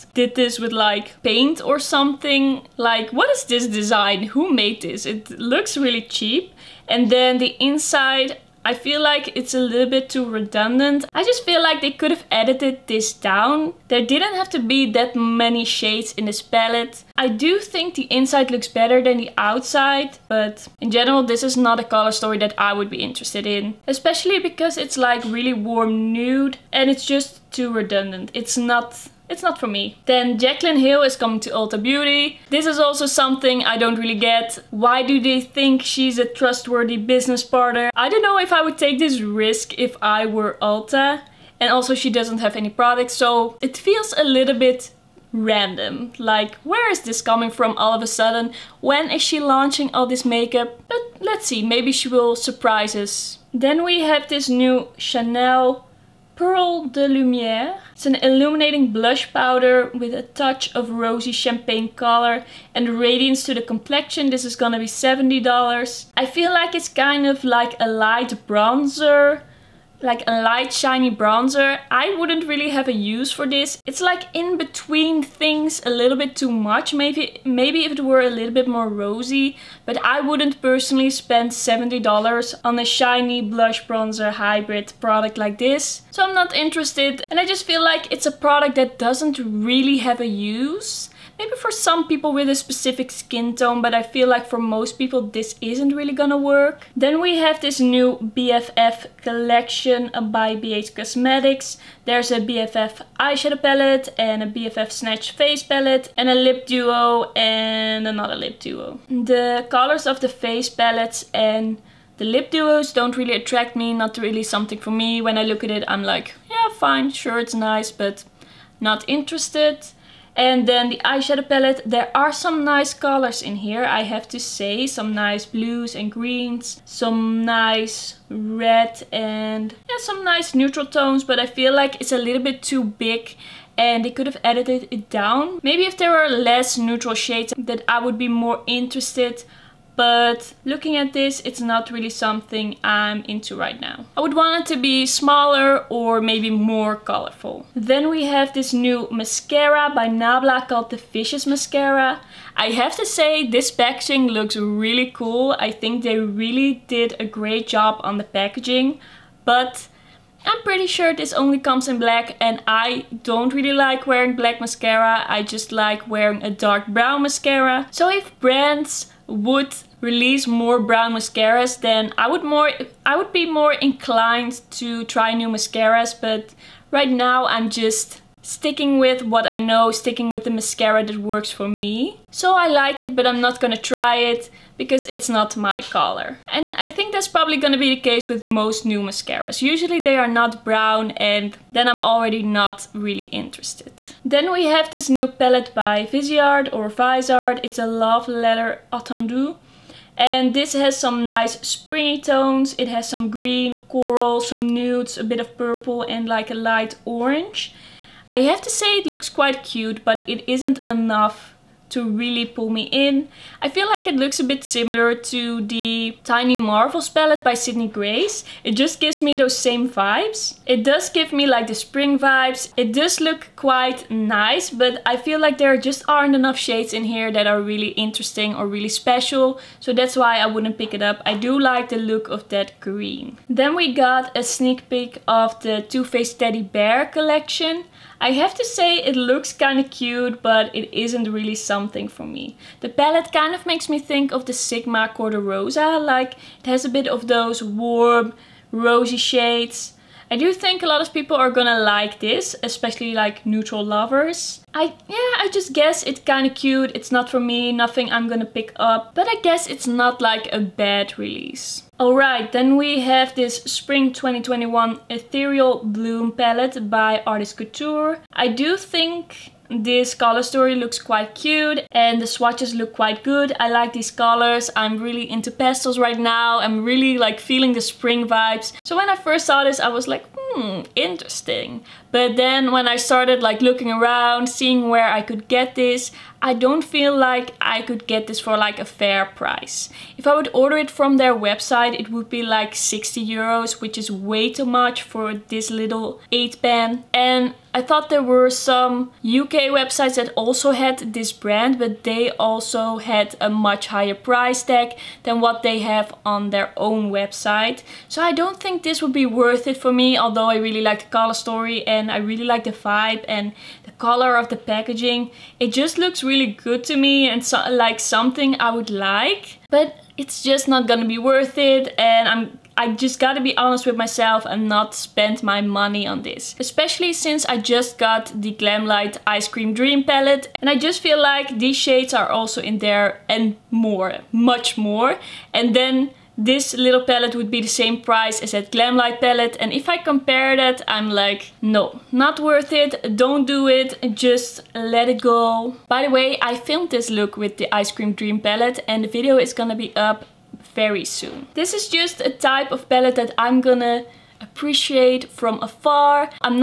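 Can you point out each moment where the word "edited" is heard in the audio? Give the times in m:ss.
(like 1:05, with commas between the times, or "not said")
0:12, 2:14.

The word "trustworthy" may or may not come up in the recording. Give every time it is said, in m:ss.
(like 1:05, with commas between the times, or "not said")
0:36.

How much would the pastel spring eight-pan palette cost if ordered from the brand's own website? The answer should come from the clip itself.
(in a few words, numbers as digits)
60 euros.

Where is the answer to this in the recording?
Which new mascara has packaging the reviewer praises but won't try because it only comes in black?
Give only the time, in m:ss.
2:30.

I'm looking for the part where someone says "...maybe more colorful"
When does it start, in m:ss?
2:26.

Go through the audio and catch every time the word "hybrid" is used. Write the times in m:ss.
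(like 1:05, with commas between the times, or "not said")
1:24.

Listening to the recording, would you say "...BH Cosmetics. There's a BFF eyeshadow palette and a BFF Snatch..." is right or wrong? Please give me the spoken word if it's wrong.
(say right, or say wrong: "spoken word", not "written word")
right.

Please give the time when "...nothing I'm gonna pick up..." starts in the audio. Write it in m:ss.
4:17.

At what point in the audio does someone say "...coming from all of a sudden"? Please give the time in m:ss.
0:47.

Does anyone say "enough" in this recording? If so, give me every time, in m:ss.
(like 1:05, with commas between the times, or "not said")
3:30, 3:46.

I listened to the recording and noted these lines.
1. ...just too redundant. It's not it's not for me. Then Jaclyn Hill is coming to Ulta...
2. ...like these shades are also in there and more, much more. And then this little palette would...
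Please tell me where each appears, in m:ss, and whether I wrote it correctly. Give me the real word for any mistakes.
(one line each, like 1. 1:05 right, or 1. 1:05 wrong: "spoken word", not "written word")
1. 0:27 right
2. 5:31 right.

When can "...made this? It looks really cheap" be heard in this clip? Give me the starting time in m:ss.
0:04.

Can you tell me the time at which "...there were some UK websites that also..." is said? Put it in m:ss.
4:58.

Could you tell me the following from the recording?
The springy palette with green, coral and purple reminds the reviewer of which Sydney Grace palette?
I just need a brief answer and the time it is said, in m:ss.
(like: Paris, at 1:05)
Tiny Marvels, at 3:36.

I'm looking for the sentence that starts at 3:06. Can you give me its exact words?
And I think that's probably gonna be the case with most new mascaras.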